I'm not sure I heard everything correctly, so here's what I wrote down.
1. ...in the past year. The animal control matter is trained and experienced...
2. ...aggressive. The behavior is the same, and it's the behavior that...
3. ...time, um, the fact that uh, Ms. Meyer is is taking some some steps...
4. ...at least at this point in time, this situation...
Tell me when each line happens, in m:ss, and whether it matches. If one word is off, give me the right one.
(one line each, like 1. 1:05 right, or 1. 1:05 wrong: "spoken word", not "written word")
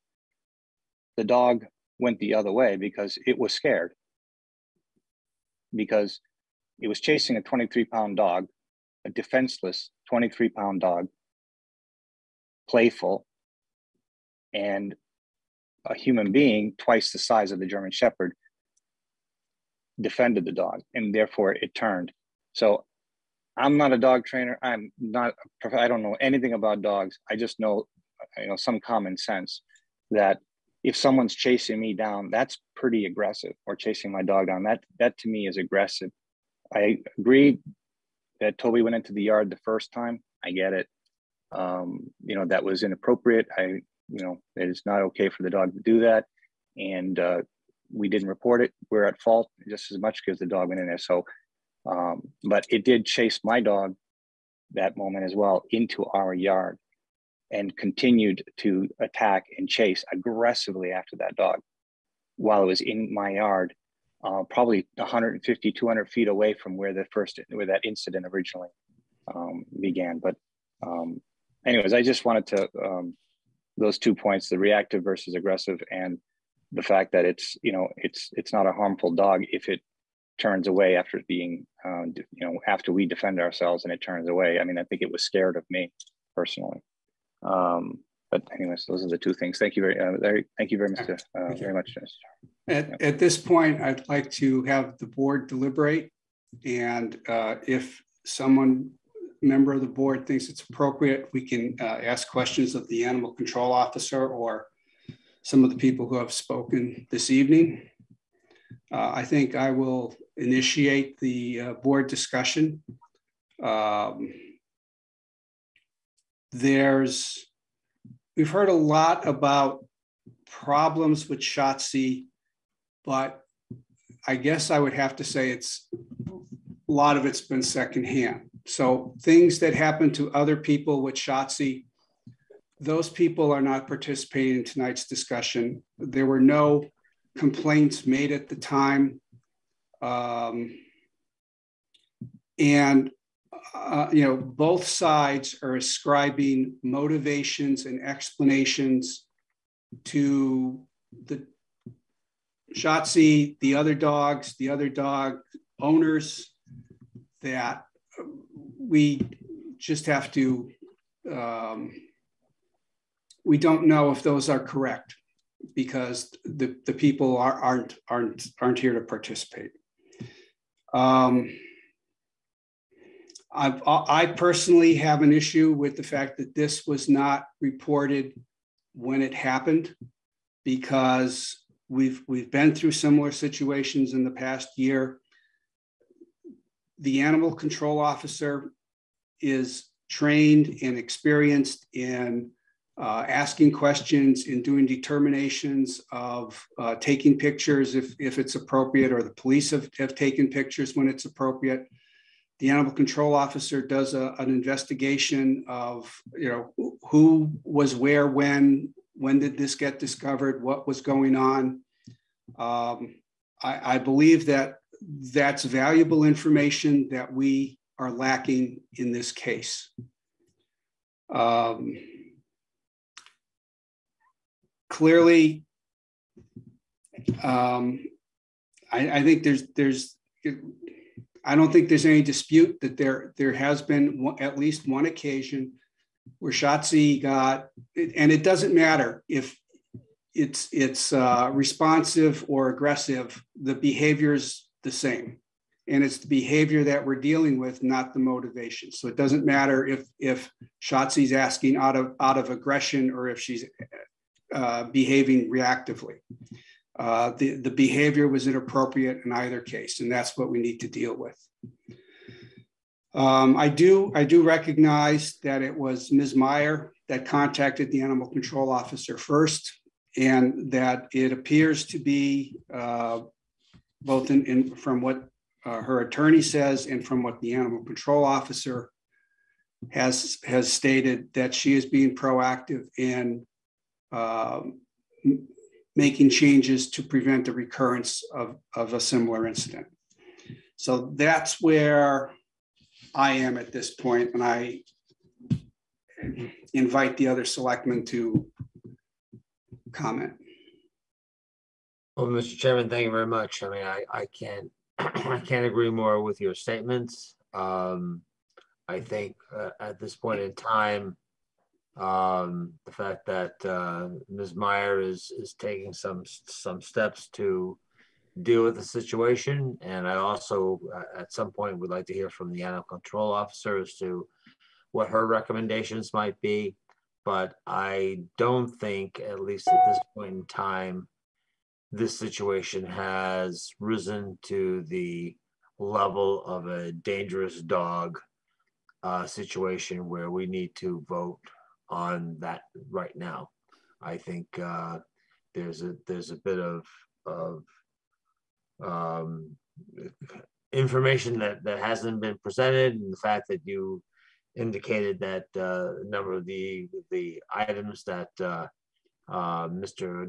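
1. 3:04 wrong: "officer", not "matter"
2. 4:02 right
3. 5:10 right
4. 5:29 right.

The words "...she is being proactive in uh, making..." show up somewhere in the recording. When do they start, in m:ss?
4:41.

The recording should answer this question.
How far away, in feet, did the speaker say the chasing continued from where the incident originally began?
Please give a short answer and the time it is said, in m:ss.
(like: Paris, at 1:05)
150 to 200 feet, at 1:04.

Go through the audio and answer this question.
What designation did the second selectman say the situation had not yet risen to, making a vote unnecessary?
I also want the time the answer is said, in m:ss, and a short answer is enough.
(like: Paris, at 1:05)
dangerous dog, at 5:36.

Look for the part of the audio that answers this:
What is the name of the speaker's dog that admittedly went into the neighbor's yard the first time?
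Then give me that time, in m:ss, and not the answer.
0:38.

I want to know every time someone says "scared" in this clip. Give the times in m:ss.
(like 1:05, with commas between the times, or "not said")
0:03, 1:25.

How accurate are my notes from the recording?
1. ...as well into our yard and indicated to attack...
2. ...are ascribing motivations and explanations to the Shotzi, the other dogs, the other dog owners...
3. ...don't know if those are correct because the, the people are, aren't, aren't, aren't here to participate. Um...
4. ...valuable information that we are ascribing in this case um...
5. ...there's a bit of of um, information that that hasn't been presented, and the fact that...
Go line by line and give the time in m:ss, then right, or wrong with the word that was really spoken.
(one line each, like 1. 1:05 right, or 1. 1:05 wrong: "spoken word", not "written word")
1. 0:55 wrong: "continued", not "indicated"
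2. 2:25 right
3. 2:43 right
4. 3:35 wrong: "lacking", not "ascribing"
5. 5:46 right.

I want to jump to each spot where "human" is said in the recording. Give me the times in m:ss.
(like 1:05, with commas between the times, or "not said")
0:15.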